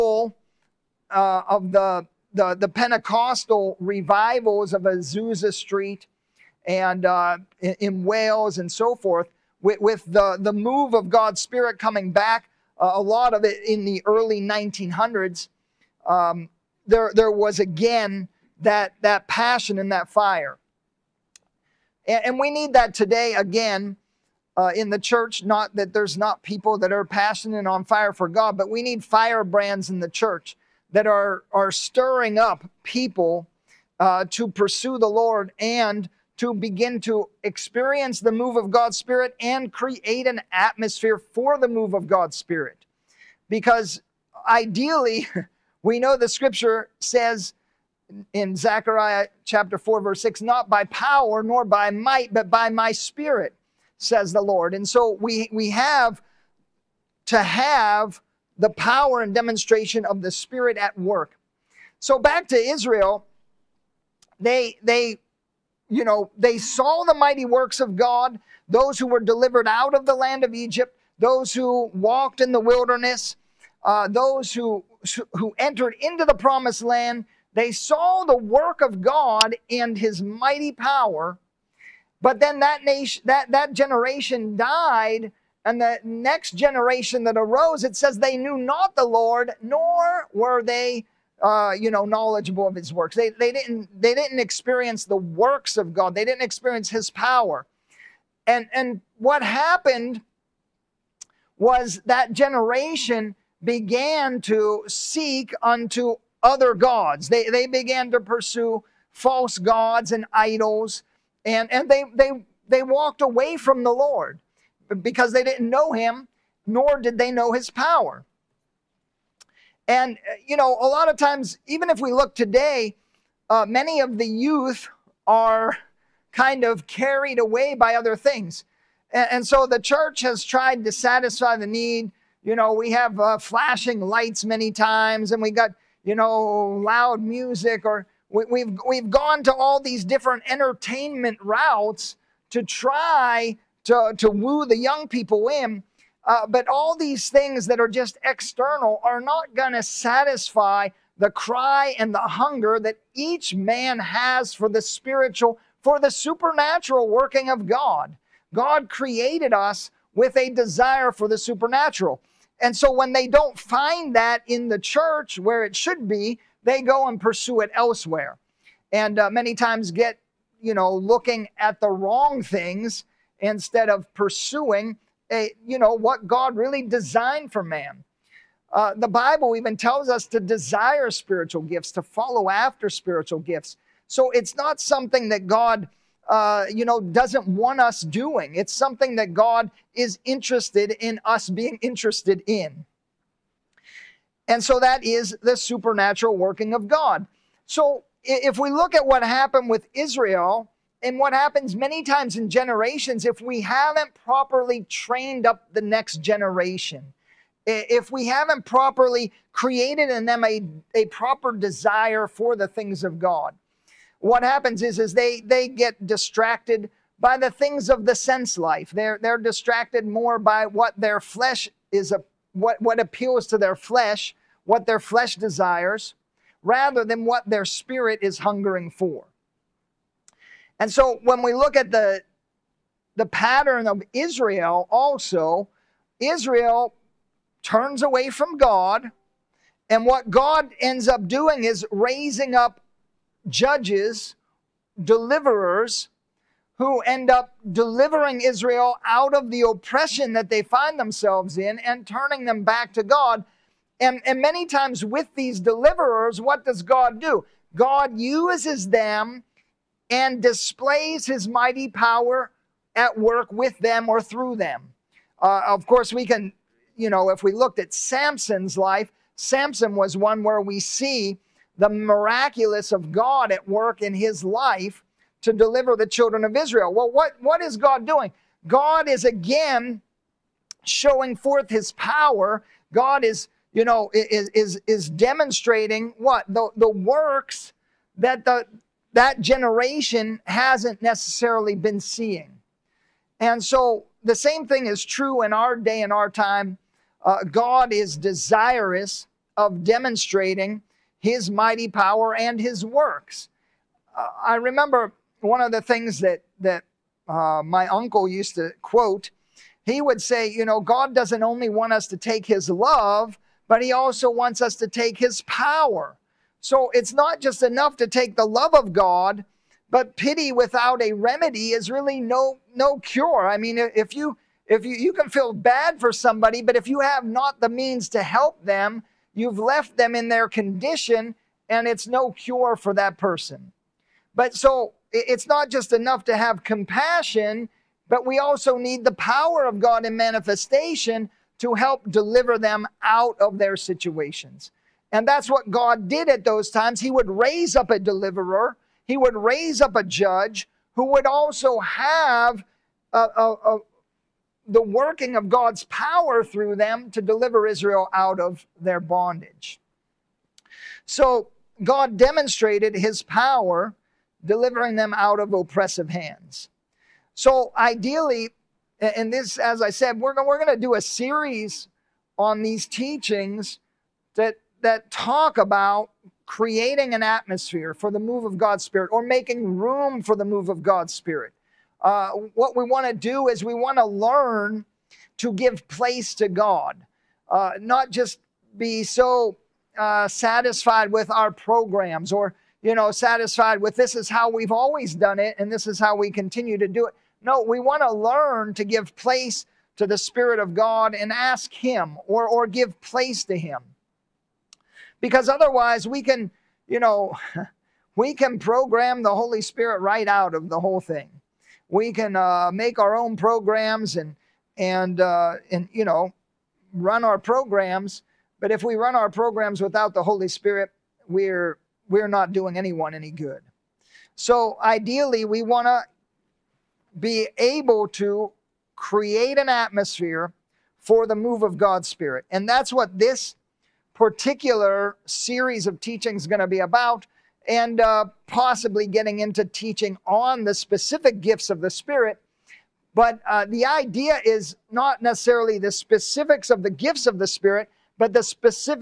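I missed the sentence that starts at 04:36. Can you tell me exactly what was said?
Well, what, what is God doing?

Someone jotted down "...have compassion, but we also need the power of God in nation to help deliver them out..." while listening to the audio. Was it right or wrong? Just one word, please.
wrong.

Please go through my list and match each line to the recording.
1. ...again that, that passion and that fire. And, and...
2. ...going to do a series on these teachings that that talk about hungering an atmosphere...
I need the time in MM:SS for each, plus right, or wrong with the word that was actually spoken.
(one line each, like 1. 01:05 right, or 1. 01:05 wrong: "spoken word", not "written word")
1. 00:17 right
2. 06:10 wrong: "creating", not "hungering".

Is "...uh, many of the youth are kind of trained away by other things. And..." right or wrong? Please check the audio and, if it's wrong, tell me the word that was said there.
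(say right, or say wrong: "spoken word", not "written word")
wrong: "carried", not "trained".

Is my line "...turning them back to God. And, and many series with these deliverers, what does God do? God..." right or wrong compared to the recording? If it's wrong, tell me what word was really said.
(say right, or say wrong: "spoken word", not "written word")
wrong: "times", not "series".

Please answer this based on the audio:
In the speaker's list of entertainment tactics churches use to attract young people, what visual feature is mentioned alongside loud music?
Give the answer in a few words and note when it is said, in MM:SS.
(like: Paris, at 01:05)
flashing lights, at 02:13.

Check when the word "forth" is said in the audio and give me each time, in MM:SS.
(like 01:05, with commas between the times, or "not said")
00:08, 04:41.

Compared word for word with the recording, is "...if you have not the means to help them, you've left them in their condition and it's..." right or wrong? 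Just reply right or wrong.
right.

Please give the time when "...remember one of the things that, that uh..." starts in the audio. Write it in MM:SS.
05:04.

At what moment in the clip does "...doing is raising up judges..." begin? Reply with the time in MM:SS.
04:01.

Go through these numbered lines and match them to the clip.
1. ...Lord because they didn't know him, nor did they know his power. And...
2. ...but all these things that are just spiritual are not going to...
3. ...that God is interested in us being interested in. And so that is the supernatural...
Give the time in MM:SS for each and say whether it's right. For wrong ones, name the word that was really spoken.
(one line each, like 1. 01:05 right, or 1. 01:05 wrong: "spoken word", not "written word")
1. 01:53 right
2. 02:26 wrong: "external", not "spiritual"
3. 03:09 right.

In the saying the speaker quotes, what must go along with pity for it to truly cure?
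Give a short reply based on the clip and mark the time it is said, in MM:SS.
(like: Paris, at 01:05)
A remedy, at 05:20.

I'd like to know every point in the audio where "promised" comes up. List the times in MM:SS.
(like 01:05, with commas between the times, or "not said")
01:16.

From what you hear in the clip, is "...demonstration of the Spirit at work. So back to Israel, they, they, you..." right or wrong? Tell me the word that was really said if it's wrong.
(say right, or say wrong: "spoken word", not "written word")
right.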